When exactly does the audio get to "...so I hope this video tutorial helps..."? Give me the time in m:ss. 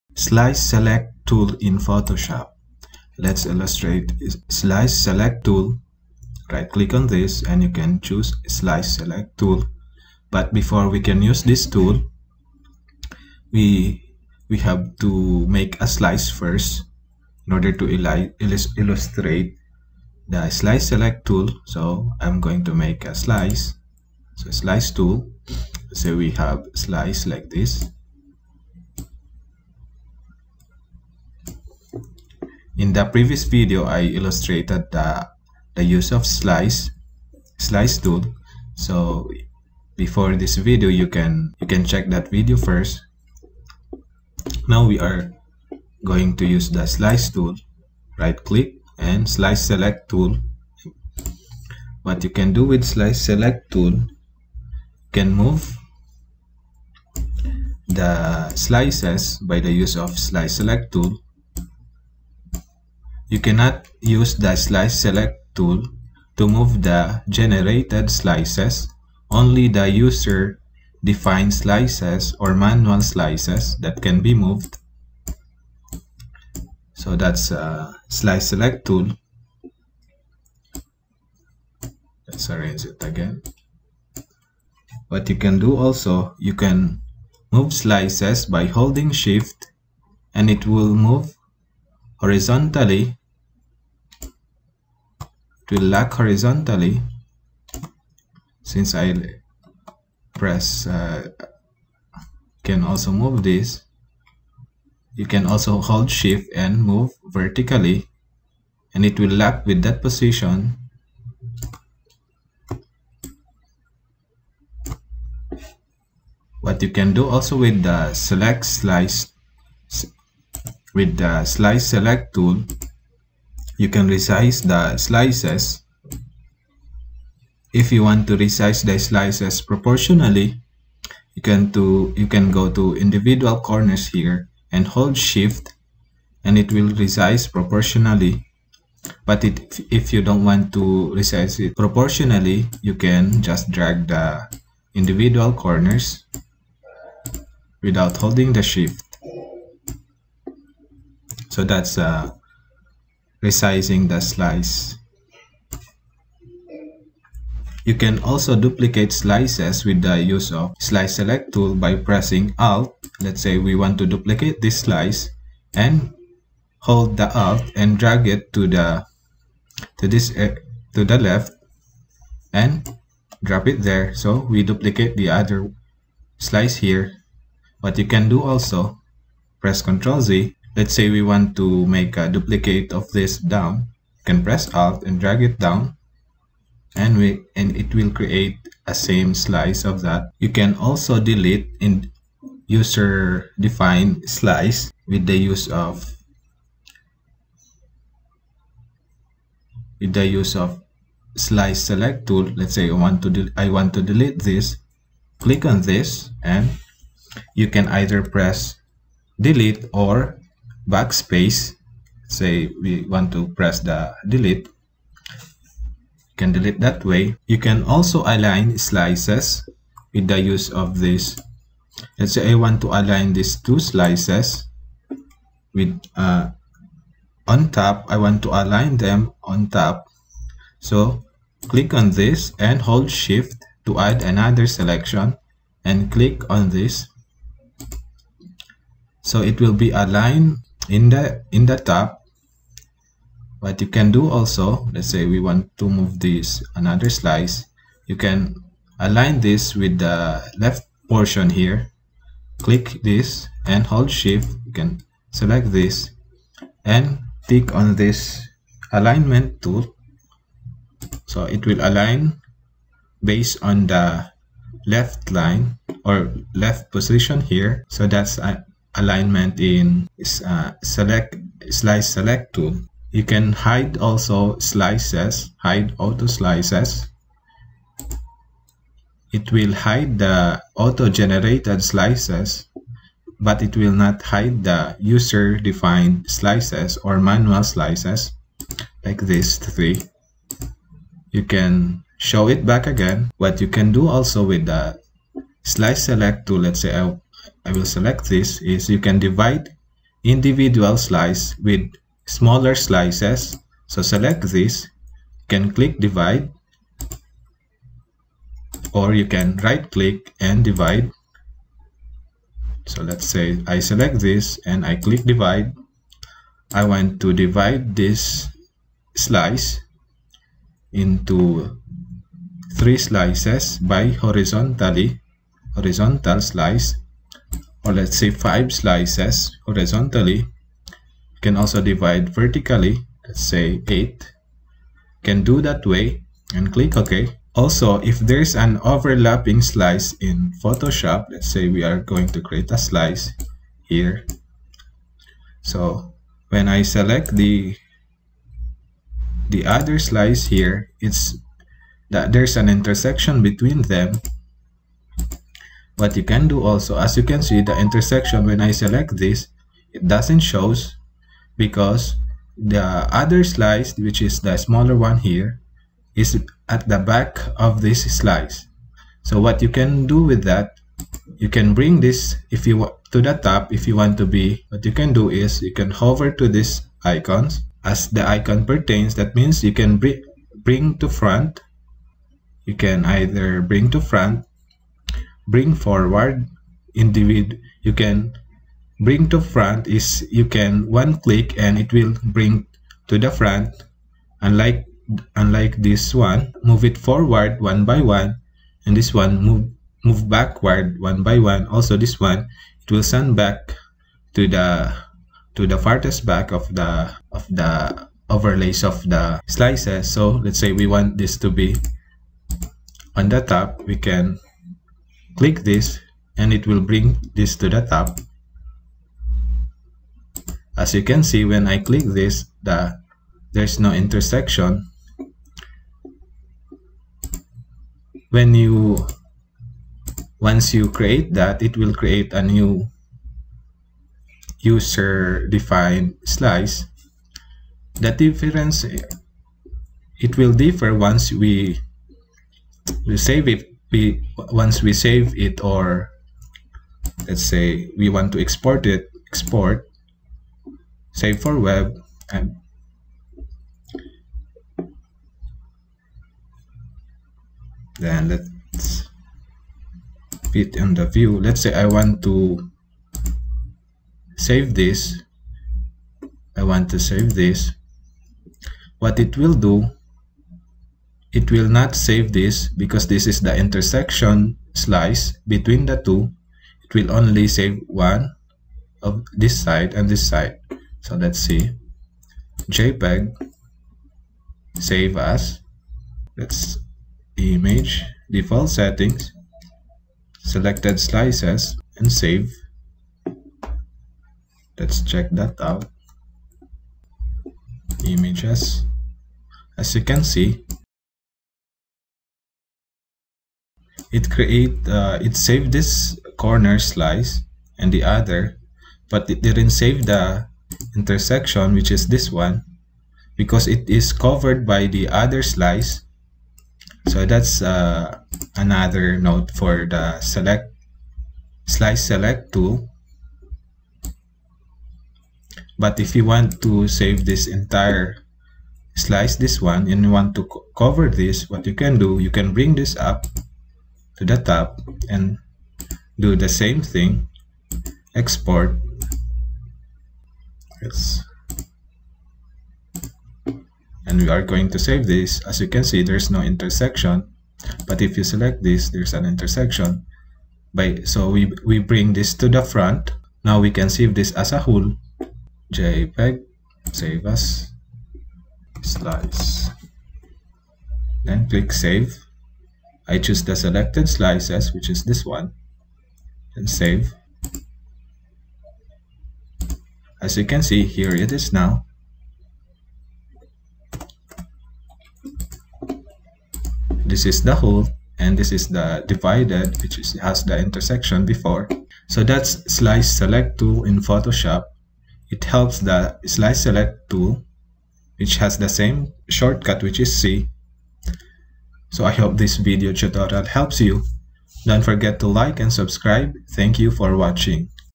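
9:51.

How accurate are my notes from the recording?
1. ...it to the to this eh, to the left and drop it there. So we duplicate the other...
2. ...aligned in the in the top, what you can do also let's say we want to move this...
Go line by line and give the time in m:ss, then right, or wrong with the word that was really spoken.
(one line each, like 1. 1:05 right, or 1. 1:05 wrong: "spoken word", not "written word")
1. 2:48 right
2. 3:59 right.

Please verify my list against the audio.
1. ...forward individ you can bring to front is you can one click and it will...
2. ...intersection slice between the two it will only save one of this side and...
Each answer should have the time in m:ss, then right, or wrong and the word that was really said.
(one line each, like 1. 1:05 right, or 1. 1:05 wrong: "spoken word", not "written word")
1. 6:25 right
2. 7:53 right.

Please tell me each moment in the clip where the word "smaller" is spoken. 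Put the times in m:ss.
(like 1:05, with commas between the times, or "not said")
5:02, 6:04.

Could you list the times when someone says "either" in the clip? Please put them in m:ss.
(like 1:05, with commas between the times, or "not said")
3:27, 6:23.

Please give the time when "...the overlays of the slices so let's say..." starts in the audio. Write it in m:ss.
6:47.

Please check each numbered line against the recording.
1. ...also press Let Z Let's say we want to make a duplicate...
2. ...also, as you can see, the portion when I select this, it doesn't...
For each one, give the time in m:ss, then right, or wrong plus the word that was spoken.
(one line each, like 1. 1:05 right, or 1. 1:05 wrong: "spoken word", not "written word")
1. 2:58 wrong: "Ctrl", not "Let"
2. 5:56 wrong: "intersection", not "portion".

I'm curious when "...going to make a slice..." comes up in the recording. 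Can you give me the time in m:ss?
0:22.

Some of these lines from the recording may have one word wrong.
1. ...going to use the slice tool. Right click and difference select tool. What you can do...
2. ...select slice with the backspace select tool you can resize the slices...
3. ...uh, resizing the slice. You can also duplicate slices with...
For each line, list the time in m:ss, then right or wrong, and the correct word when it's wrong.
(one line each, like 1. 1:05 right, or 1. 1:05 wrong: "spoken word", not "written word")
1. 0:46 wrong: "slice", not "difference"
2. 1:58 wrong: "slice", not "backspace"
3. 2:31 right.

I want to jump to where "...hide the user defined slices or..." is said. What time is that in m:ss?
4:44.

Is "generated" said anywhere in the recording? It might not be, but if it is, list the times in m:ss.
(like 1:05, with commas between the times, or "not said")
1:07, 4:41.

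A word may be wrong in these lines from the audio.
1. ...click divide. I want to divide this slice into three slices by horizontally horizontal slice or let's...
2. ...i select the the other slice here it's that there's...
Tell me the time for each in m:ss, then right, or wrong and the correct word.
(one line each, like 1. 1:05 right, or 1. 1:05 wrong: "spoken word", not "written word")
1. 5:14 right
2. 5:46 right.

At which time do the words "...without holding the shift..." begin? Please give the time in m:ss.
2:27.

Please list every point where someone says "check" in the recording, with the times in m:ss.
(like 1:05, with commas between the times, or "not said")
0:41, 8:15.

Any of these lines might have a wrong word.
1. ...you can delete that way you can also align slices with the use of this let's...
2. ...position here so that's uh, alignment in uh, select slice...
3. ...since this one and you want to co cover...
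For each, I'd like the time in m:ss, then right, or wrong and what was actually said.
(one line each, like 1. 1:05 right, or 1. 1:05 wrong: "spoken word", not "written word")
1. 3:34 right
2. 4:26 right
3. 8:48 wrong: "slice", not "since".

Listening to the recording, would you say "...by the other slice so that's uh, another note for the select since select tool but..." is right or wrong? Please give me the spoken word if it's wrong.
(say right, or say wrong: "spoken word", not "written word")
wrong: "slice", not "since".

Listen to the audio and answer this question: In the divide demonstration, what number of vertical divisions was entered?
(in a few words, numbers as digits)
8.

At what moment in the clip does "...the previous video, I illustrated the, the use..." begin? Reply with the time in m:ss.
0:32.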